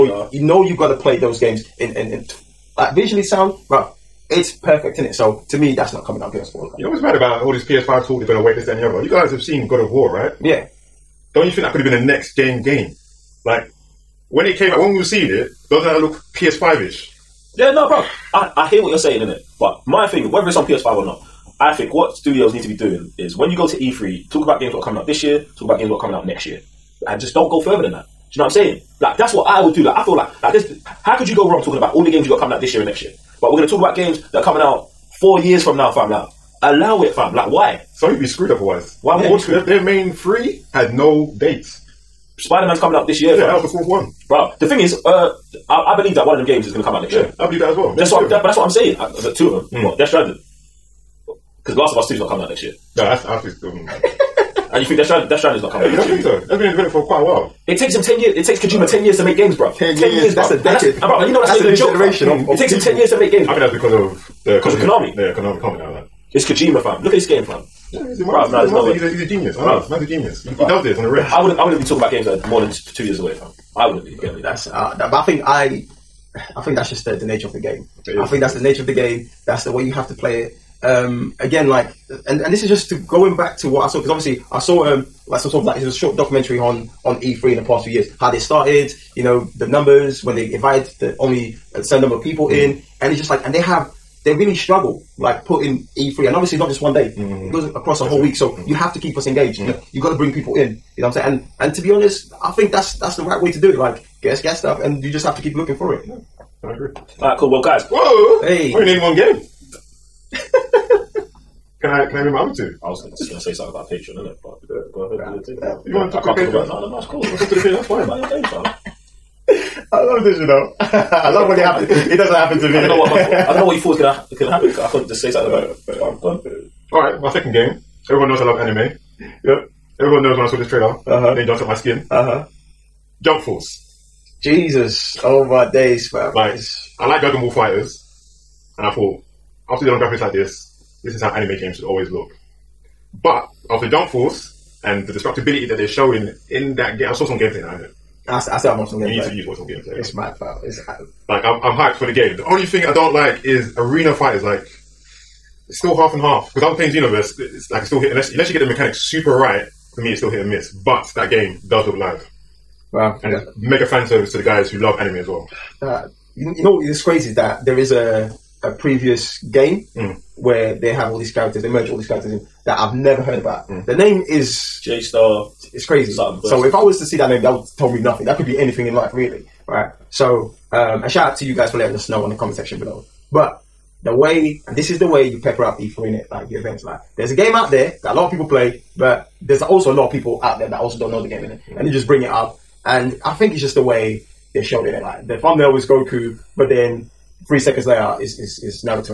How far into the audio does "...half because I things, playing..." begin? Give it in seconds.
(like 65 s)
156 s.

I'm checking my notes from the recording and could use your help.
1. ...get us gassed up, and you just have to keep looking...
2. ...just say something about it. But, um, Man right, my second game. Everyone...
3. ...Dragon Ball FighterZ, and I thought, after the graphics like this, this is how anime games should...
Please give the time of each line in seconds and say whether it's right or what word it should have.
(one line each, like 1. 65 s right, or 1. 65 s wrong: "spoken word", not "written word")
1. 104 s right
2. 125 s wrong: "All", not "Man"
3. 137 s right.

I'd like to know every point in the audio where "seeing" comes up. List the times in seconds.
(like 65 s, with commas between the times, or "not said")
15 s.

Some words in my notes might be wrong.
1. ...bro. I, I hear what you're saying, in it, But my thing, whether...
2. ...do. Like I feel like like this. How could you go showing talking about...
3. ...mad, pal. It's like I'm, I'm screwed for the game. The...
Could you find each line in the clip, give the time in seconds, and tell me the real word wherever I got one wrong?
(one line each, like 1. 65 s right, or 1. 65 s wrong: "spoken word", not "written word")
1. 17 s right
2. 29 s wrong: "wrong", not "showing"
3. 150 s wrong: "hyped", not "screwed".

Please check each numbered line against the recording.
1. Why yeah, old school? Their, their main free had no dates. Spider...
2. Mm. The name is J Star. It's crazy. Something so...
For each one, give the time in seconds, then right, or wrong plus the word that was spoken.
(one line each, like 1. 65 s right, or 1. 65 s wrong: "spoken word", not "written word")
1. 39 s right
2. 173 s right.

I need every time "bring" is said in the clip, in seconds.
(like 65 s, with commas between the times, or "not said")
100 s, 192 s.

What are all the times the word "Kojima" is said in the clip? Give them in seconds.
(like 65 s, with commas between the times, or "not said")
58 s, 66 s.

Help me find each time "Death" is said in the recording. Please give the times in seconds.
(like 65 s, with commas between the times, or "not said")
49 s, 54 s.